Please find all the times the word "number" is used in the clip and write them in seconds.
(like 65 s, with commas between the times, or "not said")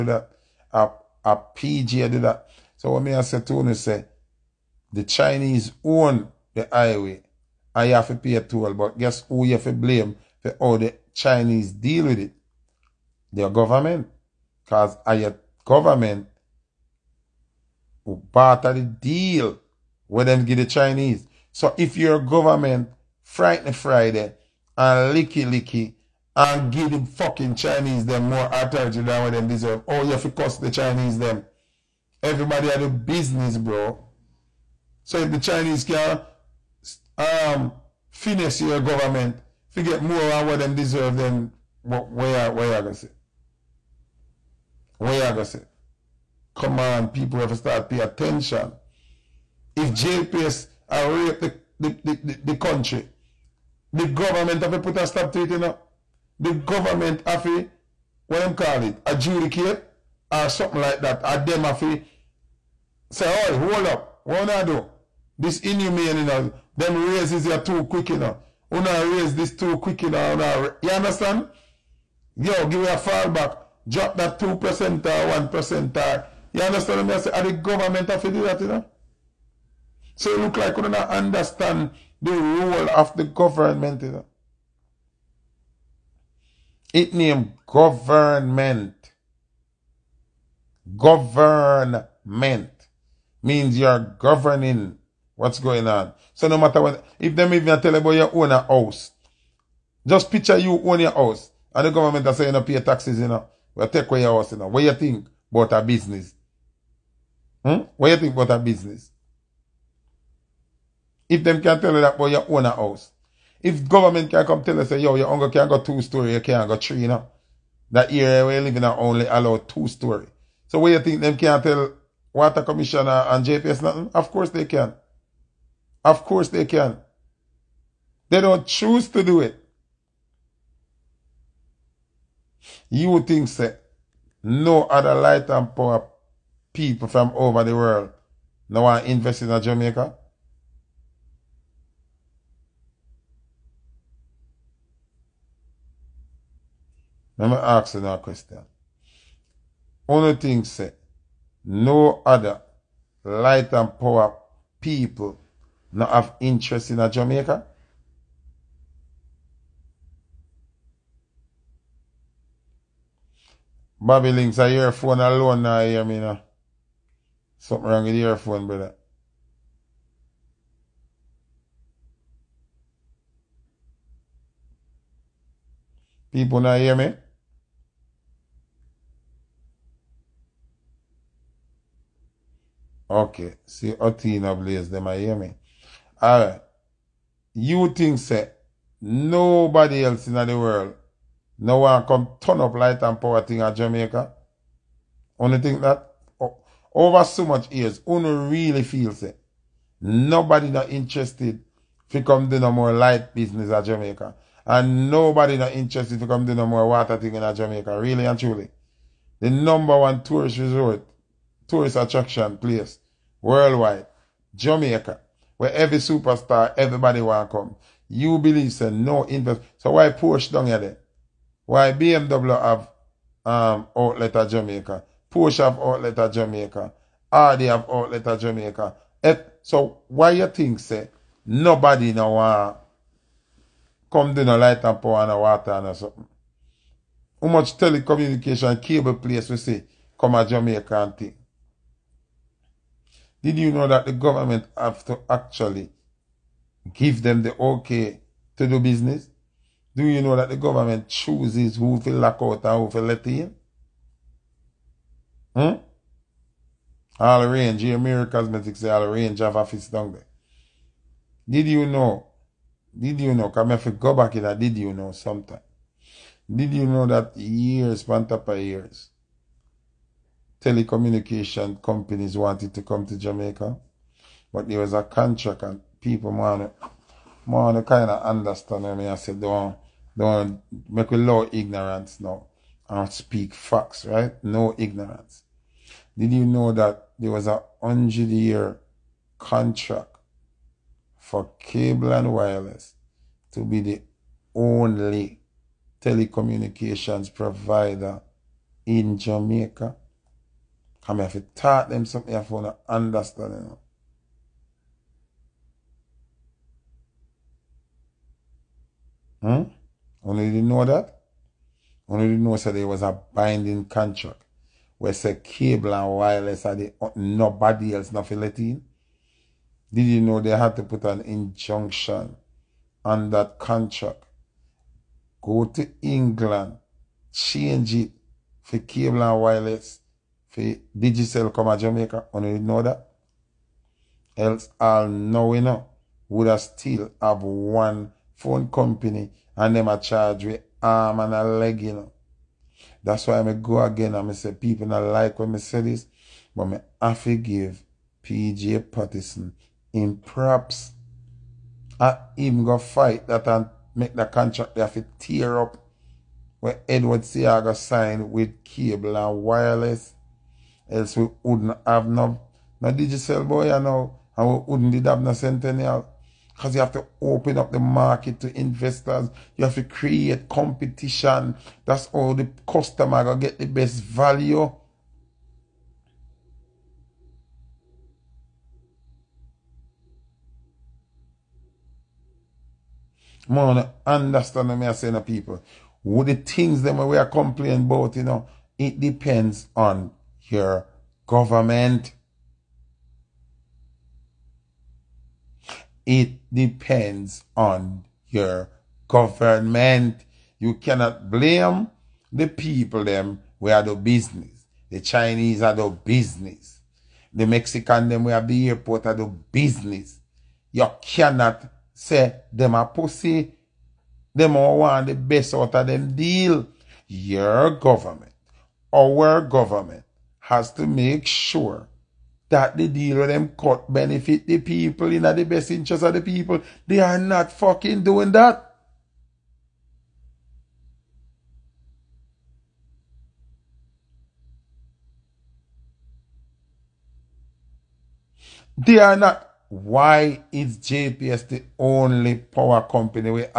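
209 s.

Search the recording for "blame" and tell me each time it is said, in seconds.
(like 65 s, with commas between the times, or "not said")
9 s, 401 s.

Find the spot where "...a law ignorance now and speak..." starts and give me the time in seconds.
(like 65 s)
281 s.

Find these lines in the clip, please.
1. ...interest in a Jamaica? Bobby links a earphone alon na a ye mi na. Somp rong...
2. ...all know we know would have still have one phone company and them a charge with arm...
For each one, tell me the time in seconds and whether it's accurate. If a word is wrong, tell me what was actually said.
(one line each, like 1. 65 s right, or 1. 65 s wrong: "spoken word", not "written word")
1. 156 s right
2. 334 s right.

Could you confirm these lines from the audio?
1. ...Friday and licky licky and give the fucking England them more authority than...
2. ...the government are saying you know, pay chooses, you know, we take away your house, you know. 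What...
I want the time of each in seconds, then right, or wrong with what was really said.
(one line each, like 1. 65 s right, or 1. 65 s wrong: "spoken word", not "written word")
1. 23 s wrong: "Chinese", not "England"
2. 101 s wrong: "taxes", not "chooses".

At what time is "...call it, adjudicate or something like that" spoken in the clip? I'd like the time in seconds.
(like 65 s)
58 s.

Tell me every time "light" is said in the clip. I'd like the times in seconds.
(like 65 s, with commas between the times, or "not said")
135 s, 153 s, 192 s, 202 s, 234 s.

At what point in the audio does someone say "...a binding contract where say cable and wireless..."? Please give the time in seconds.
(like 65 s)
313 s.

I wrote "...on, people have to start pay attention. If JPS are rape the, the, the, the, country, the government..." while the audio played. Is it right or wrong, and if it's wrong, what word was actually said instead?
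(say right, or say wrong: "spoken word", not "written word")
right.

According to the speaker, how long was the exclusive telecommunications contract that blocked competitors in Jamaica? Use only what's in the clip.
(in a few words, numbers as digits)
100 years.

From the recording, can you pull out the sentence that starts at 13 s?
Their government, because our government who part the deal with them give the Chinese.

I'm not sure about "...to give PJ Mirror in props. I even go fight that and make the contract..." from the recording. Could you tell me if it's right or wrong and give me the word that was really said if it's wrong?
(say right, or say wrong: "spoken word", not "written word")
wrong: "Patterson", not "Mirror".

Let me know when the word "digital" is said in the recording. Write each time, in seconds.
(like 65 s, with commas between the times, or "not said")
330 s, 362 s.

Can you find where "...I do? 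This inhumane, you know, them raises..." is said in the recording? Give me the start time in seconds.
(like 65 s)
64 s.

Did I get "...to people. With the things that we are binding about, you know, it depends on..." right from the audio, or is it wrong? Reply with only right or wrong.
wrong.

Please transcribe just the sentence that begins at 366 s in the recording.
Because you have to open up the market to investors.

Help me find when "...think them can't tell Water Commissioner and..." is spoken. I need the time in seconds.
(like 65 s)
120 s.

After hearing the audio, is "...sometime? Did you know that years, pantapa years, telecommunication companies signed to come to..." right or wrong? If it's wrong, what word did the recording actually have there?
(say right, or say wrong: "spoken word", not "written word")
wrong: "wanted", not "signed".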